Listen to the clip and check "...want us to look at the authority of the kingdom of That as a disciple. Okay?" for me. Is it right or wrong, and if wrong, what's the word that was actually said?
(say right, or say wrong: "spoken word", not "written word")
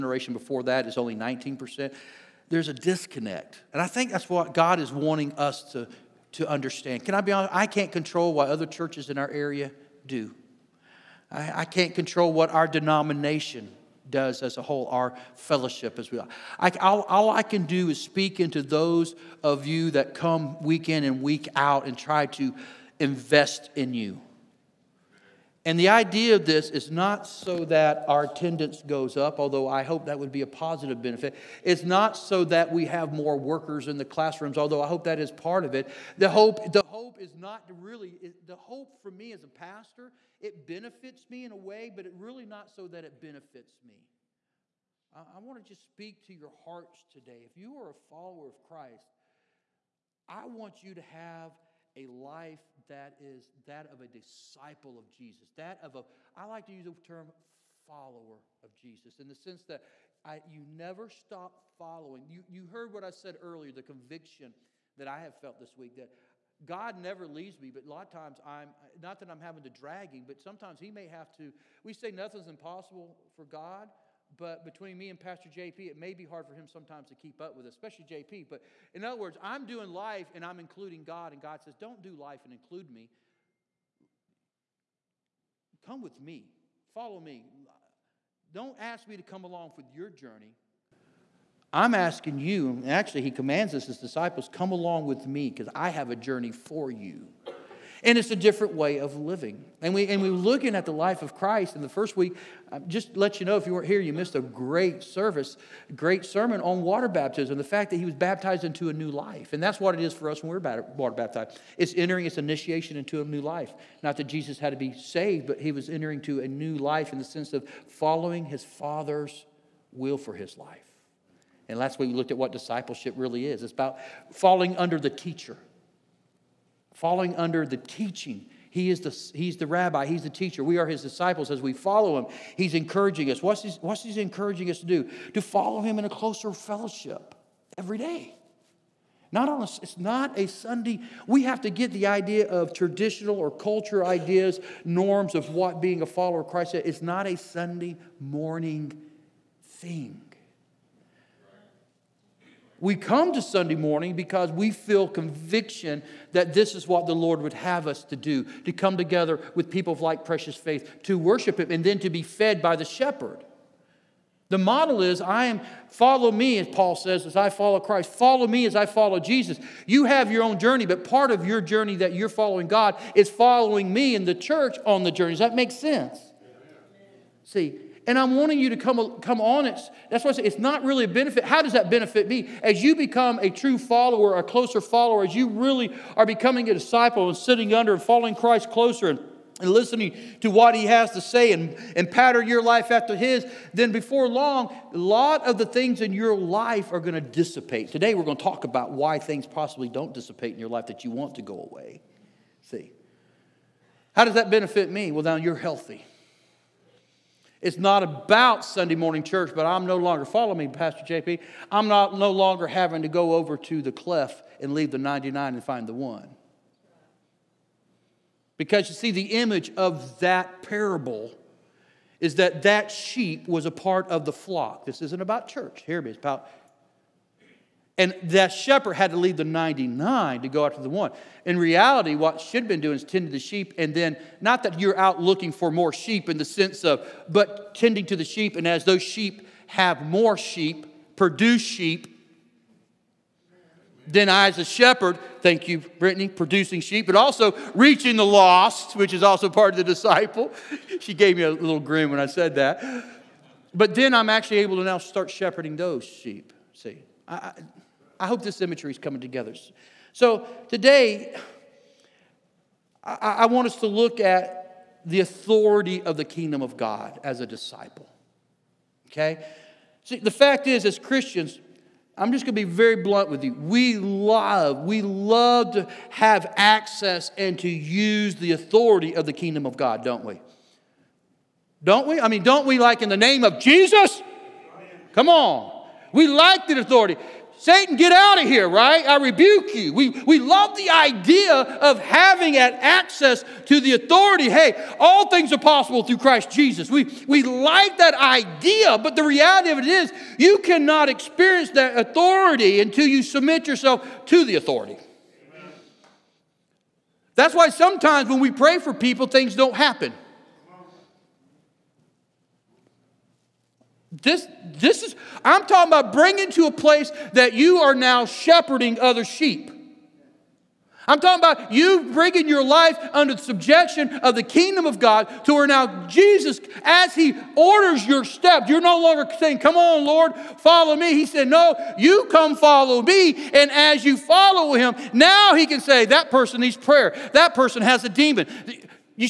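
wrong: "God", not "That".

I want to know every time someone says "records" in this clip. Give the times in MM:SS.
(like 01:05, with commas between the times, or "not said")
not said.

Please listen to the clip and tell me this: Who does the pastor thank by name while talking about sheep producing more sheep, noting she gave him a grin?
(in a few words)
Brittany.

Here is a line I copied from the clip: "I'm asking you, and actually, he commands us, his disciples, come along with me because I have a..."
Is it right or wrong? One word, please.
right.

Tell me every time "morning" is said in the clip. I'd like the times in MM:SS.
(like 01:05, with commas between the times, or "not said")
02:28, 02:33, 03:28.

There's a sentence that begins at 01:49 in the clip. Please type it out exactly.
And that's what it is for us when we're water baptized.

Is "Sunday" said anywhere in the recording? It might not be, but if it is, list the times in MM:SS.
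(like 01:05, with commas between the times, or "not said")
02:20, 02:27, 02:33, 03:28.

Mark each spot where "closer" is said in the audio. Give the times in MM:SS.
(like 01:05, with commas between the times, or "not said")
02:16, 03:04, 03:08.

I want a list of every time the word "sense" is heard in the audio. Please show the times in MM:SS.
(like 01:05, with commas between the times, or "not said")
00:59, 01:57, 02:55, 03:56.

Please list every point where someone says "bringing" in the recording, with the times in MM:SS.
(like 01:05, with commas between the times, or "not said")
05:16, 05:22.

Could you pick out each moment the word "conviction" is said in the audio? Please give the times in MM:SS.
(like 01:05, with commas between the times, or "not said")
01:03, 02:35.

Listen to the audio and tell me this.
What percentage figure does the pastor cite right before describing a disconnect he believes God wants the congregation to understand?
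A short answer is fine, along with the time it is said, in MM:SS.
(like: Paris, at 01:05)
19%, at 00:01.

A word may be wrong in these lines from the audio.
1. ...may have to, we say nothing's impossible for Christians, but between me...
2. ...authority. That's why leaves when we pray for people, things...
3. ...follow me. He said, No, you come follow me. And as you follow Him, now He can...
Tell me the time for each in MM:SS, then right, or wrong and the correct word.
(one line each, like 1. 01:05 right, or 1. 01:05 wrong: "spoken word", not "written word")
1. 01:10 wrong: "God", not "Christians"
2. 05:04 wrong: "sometimes", not "leaves"
3. 05:30 right.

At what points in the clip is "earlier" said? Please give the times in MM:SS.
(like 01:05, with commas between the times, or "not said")
01:03.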